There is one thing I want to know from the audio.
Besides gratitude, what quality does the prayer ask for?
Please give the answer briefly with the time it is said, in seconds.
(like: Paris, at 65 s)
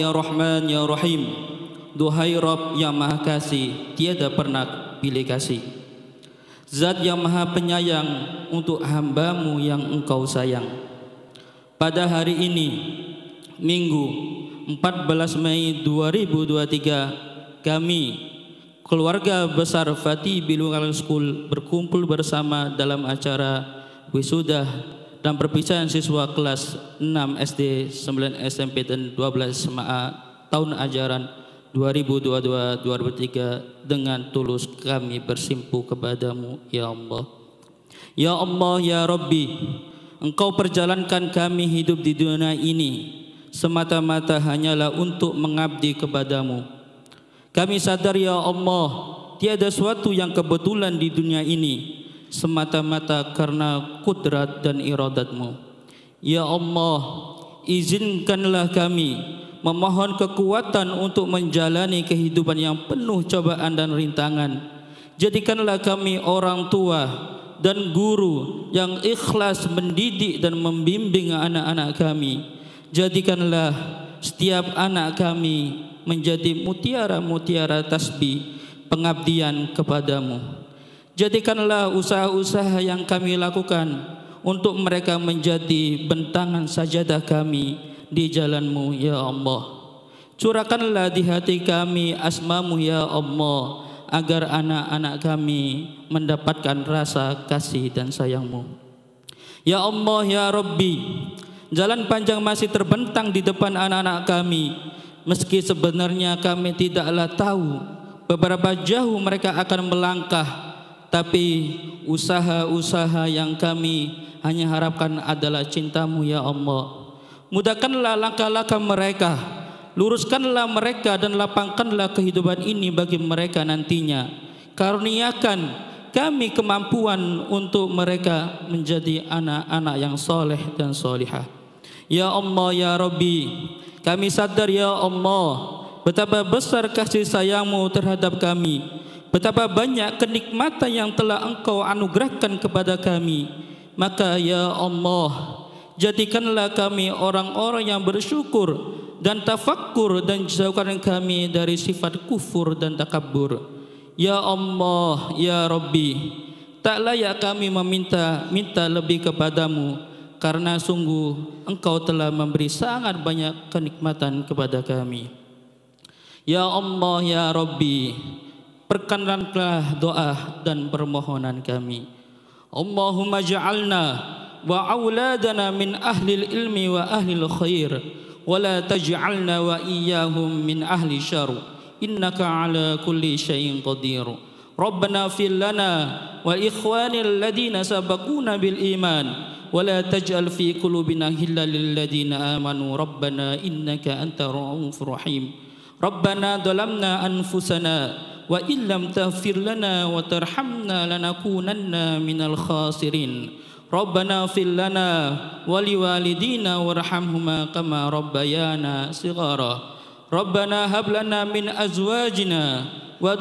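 tafakkur, at 149 s.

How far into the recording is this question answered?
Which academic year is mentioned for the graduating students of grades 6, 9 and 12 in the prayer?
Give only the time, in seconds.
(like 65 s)
31 s.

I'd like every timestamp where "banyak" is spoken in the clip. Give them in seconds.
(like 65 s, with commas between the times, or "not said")
139 s, 163 s.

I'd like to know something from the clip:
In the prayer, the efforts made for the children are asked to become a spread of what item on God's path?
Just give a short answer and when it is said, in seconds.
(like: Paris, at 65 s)
sajadah, at 86 s.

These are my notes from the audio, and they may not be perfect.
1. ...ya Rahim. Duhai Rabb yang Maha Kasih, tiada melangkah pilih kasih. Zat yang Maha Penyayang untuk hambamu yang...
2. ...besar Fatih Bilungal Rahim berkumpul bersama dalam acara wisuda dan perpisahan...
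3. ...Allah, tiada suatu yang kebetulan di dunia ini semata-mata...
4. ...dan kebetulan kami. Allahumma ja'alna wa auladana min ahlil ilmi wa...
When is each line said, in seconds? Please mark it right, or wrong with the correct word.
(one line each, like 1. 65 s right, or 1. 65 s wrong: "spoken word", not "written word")
1. 0 s wrong: "pernah", not "melangkah"
2. 19 s wrong: "School", not "Rahim"
3. 48 s right
4. 170 s wrong: "permohonan", not "kebetulan".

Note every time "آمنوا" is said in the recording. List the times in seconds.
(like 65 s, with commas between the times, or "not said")
192 s.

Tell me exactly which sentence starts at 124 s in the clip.
Karuniakan kami kemampuan untuk mereka menjadi anak-anak yang soleh dan solihah.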